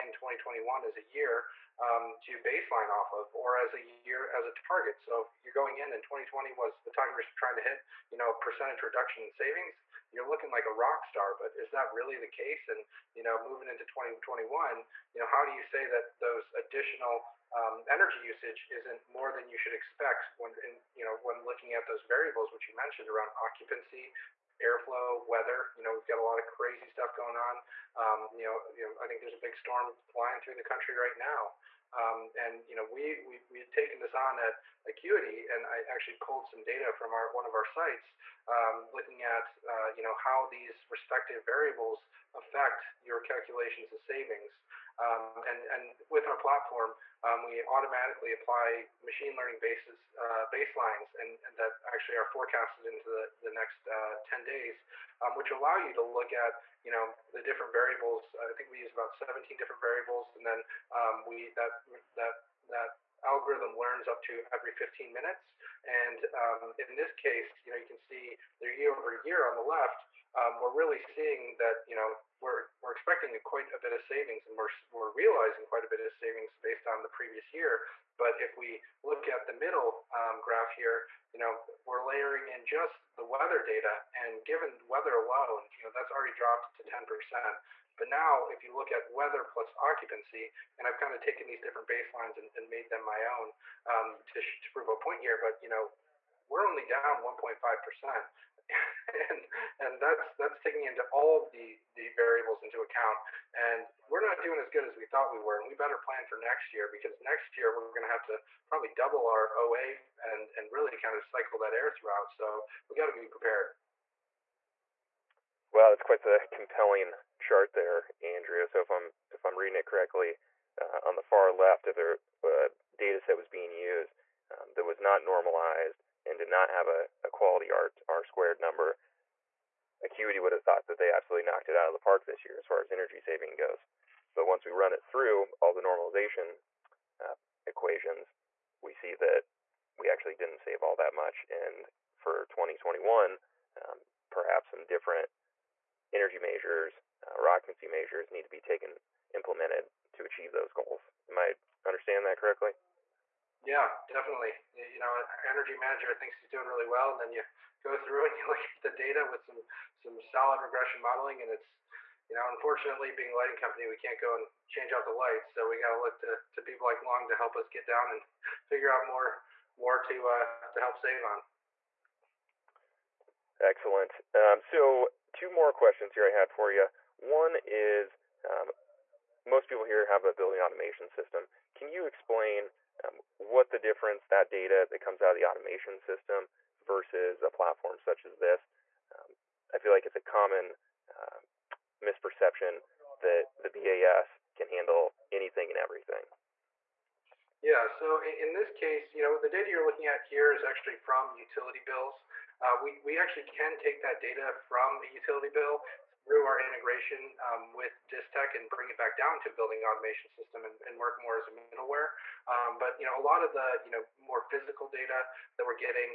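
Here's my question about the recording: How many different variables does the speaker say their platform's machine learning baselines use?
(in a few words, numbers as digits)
17.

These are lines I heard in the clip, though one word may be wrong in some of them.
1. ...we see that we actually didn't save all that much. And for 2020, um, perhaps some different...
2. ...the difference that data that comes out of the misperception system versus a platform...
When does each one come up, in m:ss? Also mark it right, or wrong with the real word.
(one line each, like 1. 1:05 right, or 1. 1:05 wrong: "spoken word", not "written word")
1. 2:18 wrong: "2021", not "2020"
2. 3:03 wrong: "automation", not "misperception".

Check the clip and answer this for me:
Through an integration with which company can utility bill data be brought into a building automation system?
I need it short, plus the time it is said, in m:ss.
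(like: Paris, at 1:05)
Distech, at 3:28.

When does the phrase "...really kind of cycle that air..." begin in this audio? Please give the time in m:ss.
1:50.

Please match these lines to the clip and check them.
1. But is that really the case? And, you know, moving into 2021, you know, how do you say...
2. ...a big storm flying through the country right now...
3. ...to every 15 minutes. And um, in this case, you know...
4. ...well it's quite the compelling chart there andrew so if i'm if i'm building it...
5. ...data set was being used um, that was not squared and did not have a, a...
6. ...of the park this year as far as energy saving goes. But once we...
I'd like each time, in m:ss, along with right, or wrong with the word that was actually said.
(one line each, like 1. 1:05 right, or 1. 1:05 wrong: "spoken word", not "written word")
1. 0:11 right
2. 0:29 right
3. 1:04 right
4. 1:55 wrong: "reading", not "building"
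5. 2:02 wrong: "normalized", not "squared"
6. 2:11 right.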